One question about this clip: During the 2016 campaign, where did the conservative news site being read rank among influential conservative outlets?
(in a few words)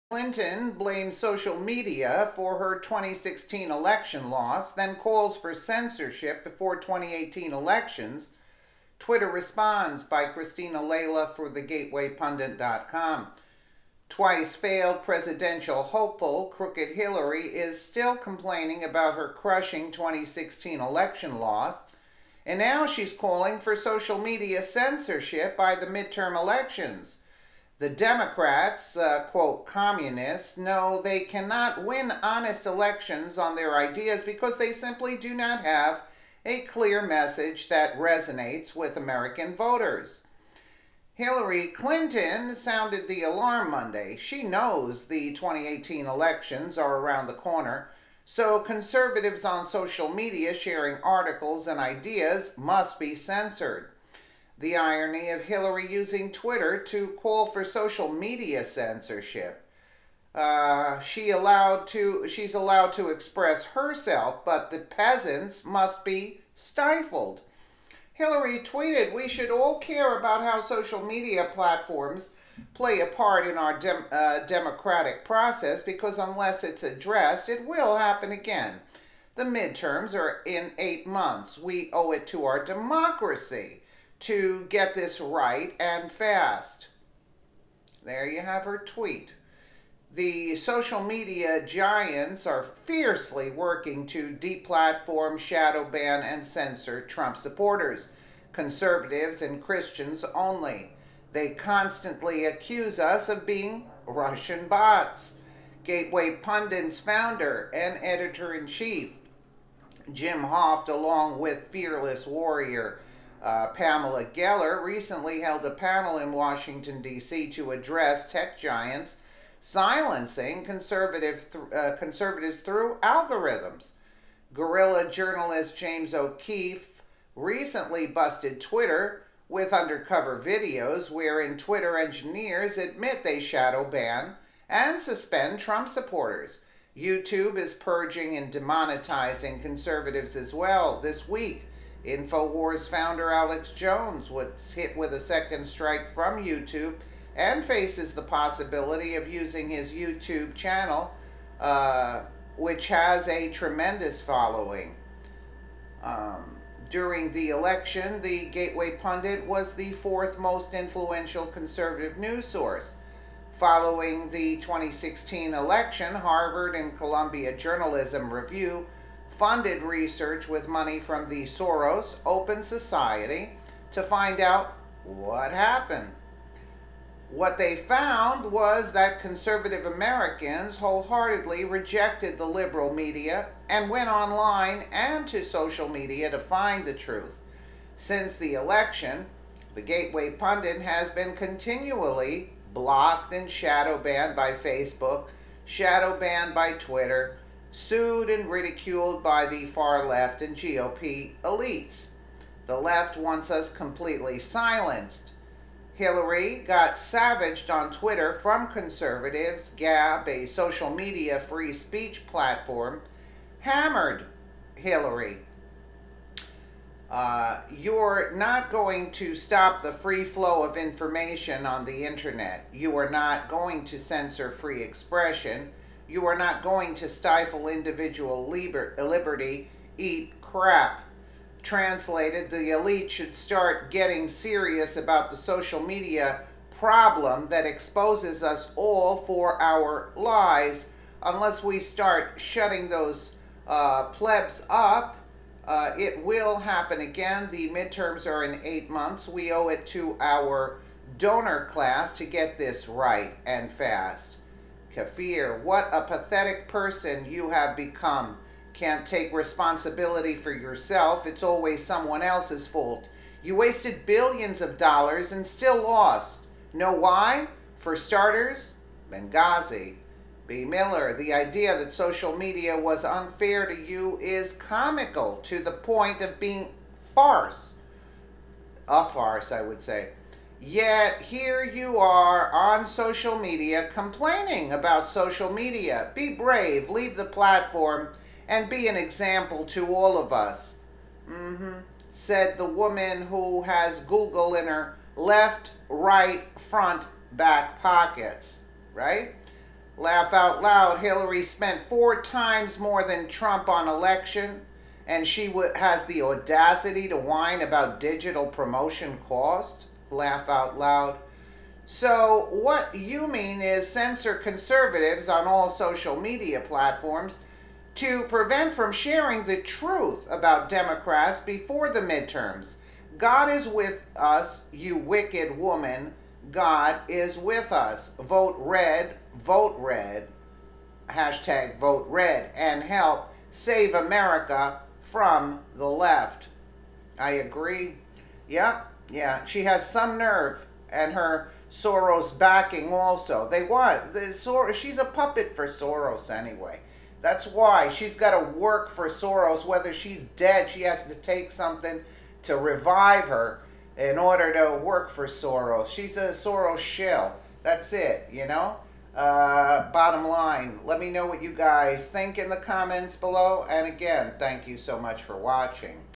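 fourth.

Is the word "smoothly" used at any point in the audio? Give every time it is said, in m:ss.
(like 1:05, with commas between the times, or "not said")
not said.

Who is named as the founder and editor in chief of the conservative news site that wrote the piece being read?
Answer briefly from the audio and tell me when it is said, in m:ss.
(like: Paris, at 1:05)
Jim Hoft, at 1:50.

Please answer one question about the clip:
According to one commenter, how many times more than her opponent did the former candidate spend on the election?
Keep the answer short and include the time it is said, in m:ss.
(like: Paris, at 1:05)
4, at 5:01.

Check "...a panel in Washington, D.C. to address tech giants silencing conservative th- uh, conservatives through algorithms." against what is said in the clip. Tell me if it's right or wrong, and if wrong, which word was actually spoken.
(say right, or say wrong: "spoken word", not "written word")
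right.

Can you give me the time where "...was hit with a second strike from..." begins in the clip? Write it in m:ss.
2:24.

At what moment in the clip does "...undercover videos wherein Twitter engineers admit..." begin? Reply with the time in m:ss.
2:09.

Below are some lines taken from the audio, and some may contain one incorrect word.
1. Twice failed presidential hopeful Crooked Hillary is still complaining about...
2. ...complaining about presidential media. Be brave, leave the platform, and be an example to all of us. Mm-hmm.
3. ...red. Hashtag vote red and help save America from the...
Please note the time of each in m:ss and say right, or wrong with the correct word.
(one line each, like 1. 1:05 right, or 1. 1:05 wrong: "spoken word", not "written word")
1. 0:14 right
2. 4:43 wrong: "social", not "presidential"
3. 5:29 right.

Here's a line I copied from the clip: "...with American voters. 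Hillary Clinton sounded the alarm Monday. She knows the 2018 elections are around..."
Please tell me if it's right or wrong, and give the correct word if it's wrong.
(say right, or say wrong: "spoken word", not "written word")
right.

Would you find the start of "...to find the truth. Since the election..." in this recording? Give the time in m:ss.
3:06.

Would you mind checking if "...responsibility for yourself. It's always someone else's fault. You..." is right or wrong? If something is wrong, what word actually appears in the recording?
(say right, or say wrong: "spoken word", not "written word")
right.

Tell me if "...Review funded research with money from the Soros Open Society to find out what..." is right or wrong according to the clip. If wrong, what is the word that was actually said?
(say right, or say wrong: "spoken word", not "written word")
right.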